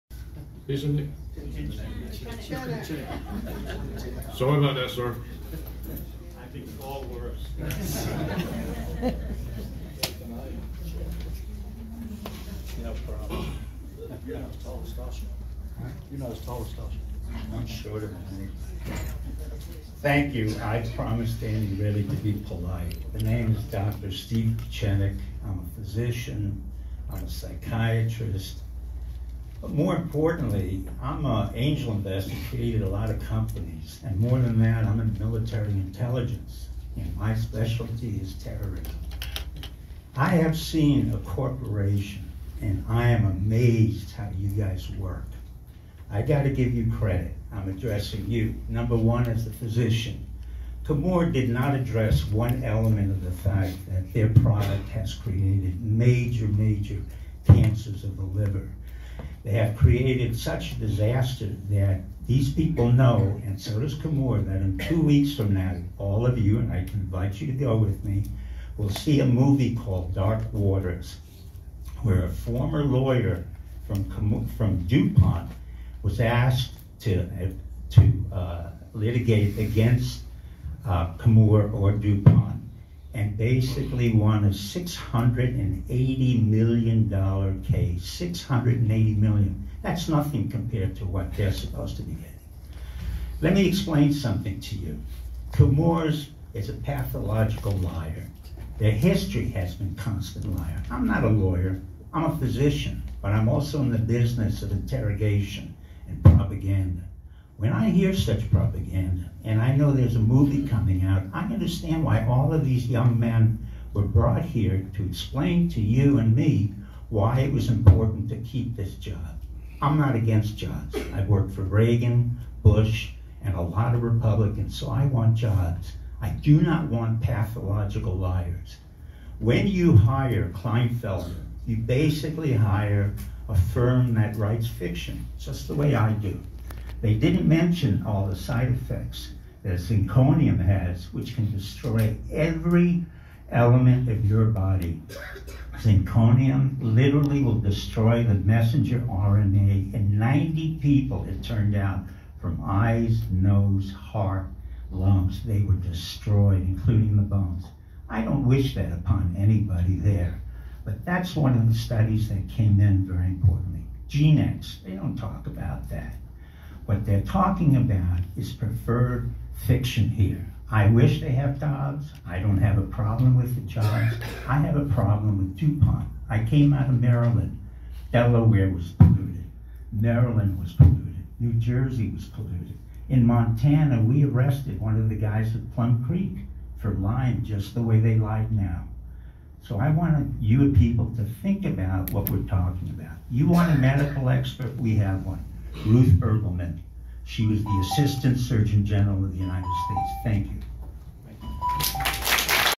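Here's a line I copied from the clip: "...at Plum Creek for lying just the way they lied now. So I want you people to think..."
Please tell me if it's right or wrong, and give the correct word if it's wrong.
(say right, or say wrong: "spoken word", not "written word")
right.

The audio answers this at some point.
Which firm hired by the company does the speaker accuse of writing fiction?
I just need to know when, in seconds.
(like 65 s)
130 s.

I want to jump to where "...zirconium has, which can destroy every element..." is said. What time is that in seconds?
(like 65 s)
139 s.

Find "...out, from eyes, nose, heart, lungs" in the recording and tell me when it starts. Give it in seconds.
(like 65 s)
151 s.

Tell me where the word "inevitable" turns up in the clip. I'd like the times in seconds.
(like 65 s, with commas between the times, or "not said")
not said.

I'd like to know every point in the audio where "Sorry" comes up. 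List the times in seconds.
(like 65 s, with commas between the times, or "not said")
4 s.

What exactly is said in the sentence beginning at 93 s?
Let me explain something to you.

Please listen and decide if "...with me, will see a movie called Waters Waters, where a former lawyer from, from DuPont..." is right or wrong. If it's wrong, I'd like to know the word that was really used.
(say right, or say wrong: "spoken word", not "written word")
wrong: "Dark", not "Waters".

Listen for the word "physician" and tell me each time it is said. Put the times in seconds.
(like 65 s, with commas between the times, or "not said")
25 s, 49 s, 102 s.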